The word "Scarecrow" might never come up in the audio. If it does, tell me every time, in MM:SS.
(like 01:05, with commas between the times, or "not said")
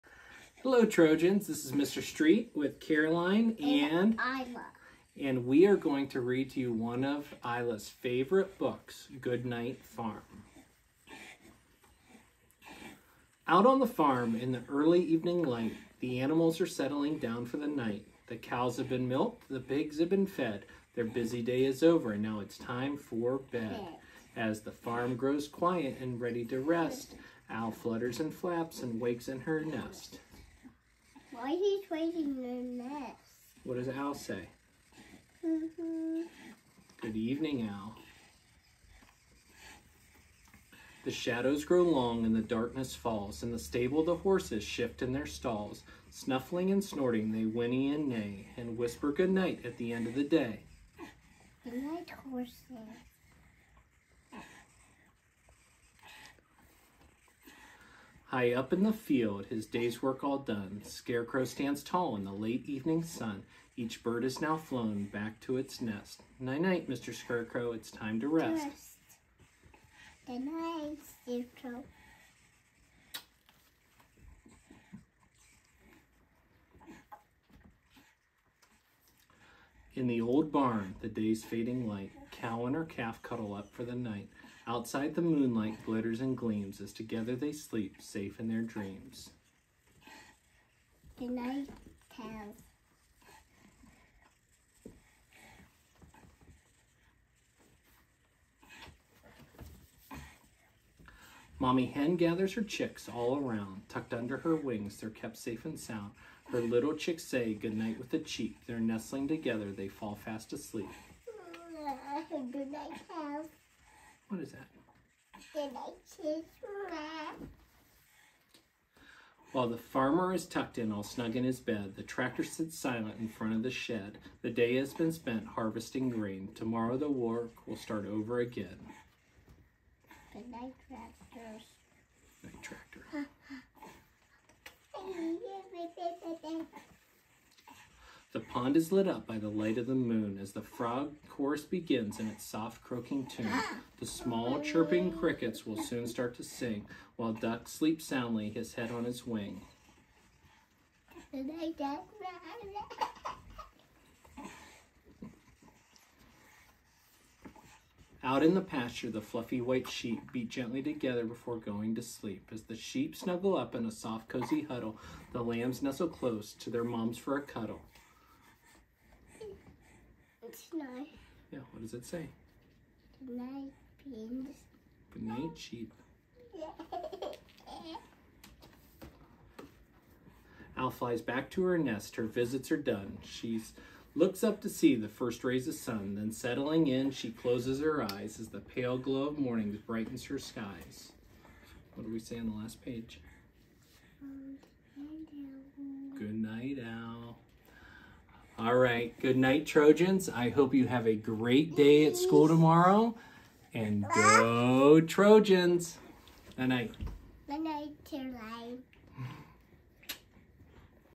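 01:00, 01:07, 01:11.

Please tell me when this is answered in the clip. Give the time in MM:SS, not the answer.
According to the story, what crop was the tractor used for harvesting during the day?
02:06.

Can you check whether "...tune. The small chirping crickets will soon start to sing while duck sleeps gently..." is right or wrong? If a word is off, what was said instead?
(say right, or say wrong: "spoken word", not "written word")
wrong: "soundly", not "gently".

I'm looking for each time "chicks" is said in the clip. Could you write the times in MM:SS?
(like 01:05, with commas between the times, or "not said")
01:42, 01:46.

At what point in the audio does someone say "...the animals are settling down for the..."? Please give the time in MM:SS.
00:15.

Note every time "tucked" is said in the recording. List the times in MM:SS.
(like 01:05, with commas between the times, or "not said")
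01:43, 02:00.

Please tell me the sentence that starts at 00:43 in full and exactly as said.
In the stable, the horses shift in their stalls.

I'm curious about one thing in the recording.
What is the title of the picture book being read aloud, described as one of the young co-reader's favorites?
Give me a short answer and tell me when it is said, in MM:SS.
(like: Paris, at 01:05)
Goodnight Farm, at 00:09.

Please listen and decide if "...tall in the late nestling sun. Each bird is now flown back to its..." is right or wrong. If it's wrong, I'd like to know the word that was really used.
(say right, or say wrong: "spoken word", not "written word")
wrong: "evening", not "nestling".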